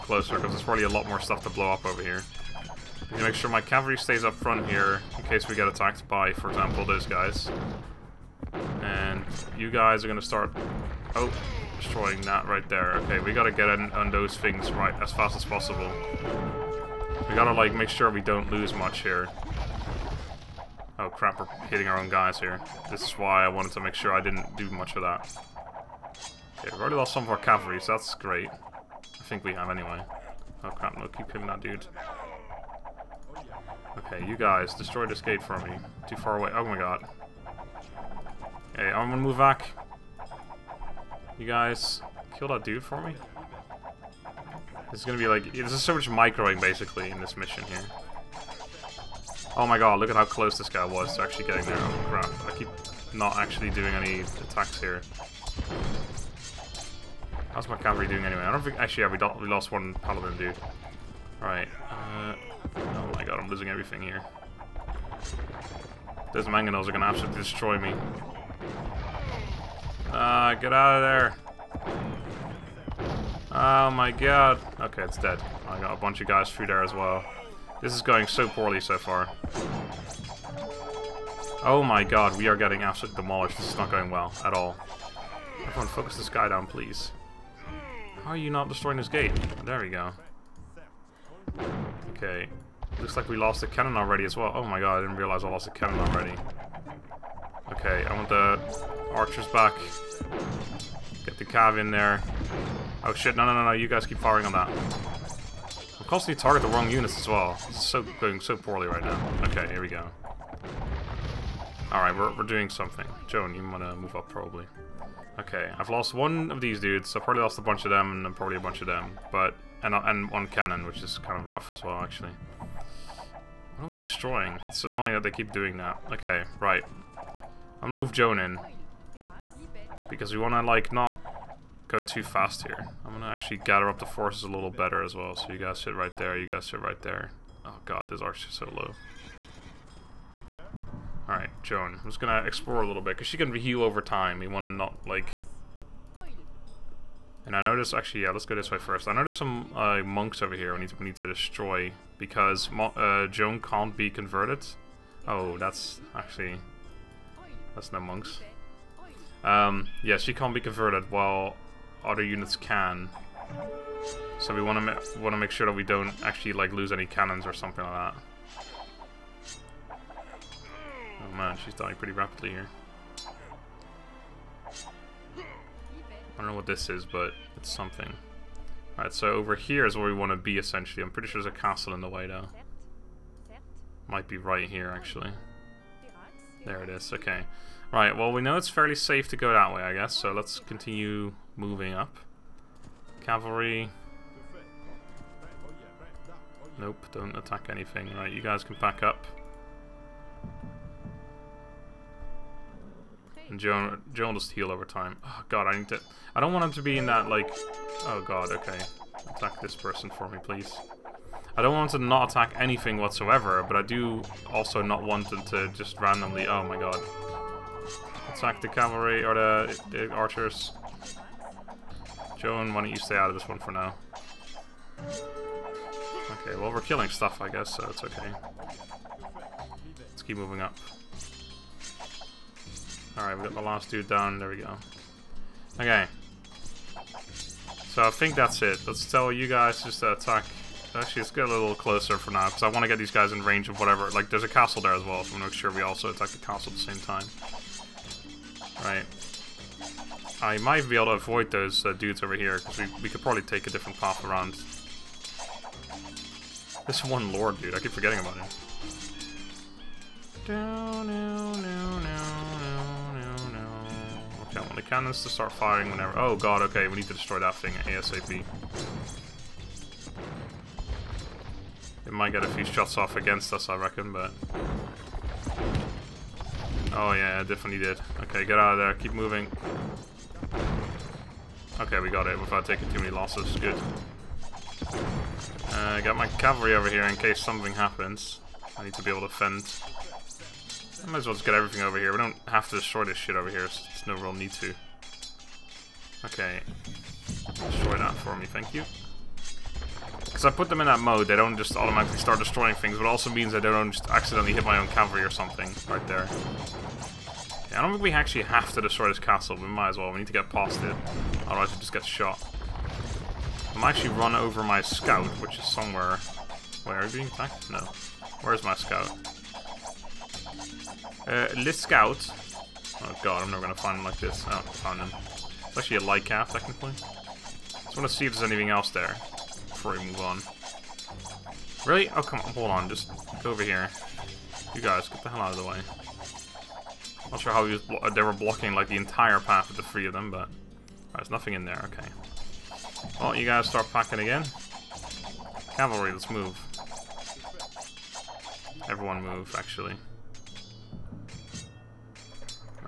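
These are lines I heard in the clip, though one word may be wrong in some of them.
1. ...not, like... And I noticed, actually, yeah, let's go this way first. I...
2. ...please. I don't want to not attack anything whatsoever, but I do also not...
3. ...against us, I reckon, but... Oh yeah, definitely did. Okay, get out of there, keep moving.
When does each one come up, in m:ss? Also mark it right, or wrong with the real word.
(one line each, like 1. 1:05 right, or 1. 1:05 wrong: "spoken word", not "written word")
1. 2:24 right
2. 3:30 right
3. 4:33 right.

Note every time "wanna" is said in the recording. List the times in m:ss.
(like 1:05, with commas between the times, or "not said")
2:24, 5:27.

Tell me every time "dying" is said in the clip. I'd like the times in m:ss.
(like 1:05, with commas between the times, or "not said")
2:51.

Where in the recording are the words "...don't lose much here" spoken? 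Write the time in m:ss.
0:18.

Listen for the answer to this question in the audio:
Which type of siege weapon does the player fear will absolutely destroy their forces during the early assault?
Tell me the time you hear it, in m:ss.
1:06.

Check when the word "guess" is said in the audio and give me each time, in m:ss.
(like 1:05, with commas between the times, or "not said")
3:09, 3:47.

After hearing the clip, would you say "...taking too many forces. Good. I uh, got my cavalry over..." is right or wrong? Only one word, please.
wrong.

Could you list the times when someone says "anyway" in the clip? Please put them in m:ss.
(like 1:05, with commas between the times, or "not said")
0:29, 0:58.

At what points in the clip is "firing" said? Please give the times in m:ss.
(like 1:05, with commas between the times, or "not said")
1:44, 4:25.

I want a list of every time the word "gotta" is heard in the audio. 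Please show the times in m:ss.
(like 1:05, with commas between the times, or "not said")
0:13, 0:17.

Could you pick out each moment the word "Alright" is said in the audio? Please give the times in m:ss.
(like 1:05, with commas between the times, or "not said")
1:51, 2:21, 2:58, 3:53.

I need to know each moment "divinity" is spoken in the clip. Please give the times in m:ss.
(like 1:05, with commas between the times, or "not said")
not said.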